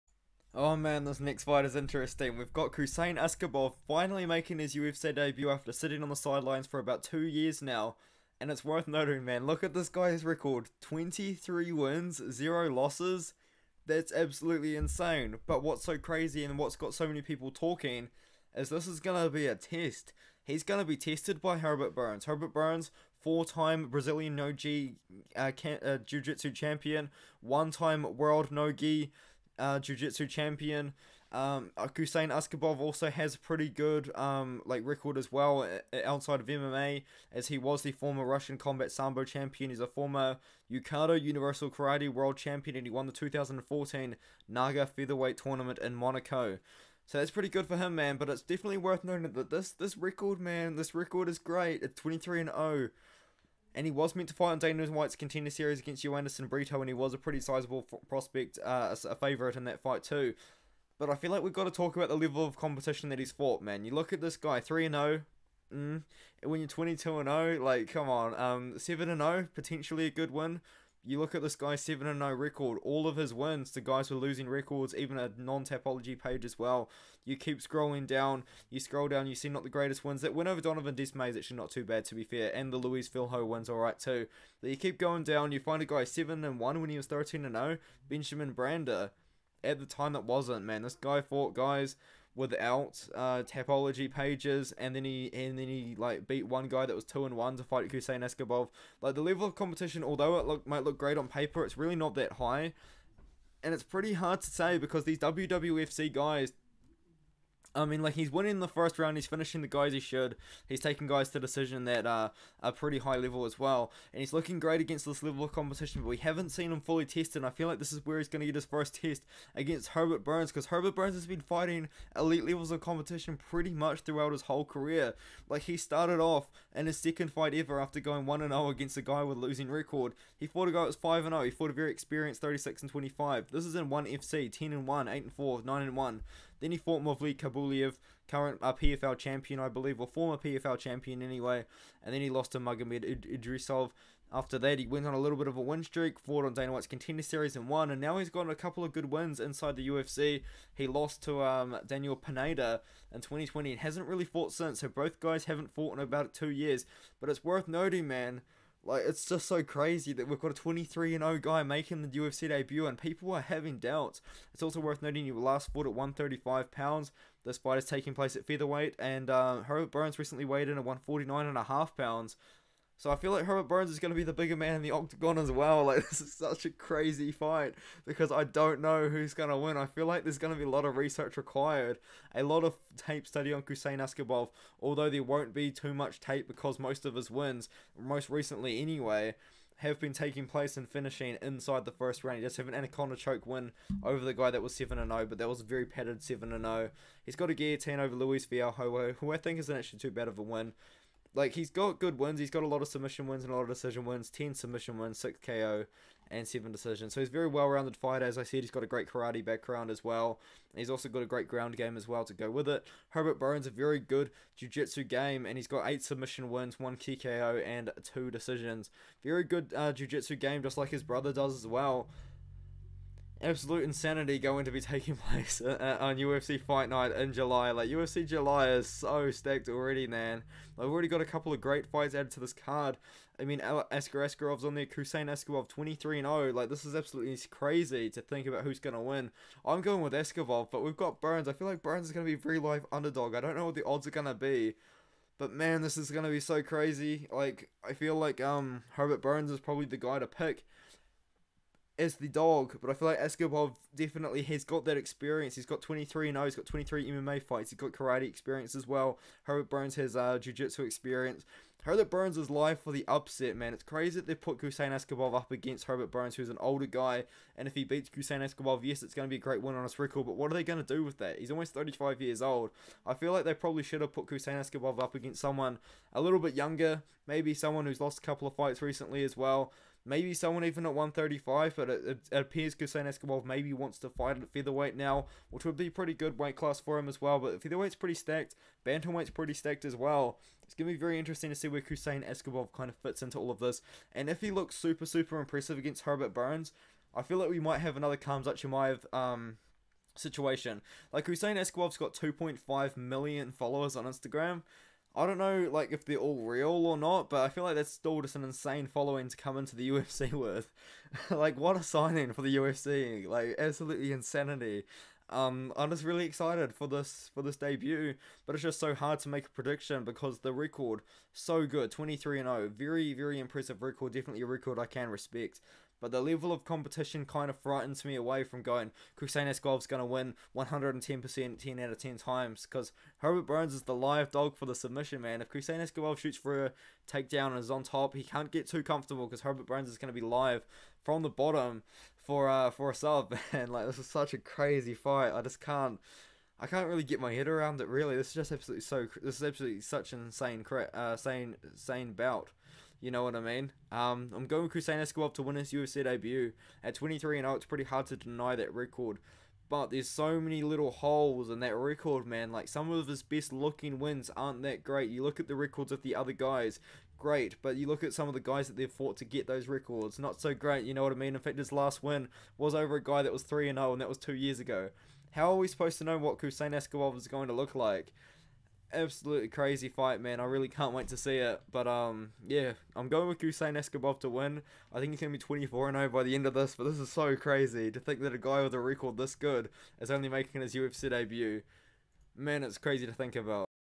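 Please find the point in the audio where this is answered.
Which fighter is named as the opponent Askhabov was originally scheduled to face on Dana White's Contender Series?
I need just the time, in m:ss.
0:56.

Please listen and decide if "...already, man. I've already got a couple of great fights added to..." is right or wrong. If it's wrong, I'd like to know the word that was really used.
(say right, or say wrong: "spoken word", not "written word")
right.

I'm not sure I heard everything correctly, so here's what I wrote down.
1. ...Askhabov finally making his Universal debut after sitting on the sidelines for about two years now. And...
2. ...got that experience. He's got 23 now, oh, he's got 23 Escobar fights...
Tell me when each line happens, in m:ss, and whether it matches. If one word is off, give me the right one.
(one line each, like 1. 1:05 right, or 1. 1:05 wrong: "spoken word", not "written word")
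1. 0:03 wrong: "UFC", not "Universal"
2. 4:14 wrong: "MMA", not "Escobar".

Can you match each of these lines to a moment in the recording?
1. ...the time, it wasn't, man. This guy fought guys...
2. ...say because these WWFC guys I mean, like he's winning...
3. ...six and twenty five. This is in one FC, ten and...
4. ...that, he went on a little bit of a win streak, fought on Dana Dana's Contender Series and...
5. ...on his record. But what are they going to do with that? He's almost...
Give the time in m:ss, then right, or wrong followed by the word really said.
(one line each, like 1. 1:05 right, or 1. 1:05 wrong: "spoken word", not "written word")
1. 1:29 right
2. 1:44 right
3. 2:12 right
4. 2:24 wrong: "White", not "Dana"
5. 4:29 right.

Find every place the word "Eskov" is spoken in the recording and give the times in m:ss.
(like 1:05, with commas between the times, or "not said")
5:29, 5:35.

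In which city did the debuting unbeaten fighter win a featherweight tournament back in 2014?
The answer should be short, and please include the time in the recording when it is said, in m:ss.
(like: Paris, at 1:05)
Monaco, at 0:45.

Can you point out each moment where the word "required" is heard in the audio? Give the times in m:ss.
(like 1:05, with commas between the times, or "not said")
3:01.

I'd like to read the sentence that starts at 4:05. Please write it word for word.
But man, this is going to be so crazy.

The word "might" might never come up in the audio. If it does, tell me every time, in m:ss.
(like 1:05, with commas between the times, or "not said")
1:40, 4:57.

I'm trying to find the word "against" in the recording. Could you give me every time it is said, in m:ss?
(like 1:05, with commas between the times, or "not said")
0:55, 1:54, 1:59, 2:08, 4:25, 4:35, 4:55.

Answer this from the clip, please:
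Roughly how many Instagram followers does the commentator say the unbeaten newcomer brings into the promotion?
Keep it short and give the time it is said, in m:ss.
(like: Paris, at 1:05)
2.5 million, at 5:02.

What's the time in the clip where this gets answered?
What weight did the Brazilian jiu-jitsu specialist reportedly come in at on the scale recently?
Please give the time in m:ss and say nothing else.
2:50.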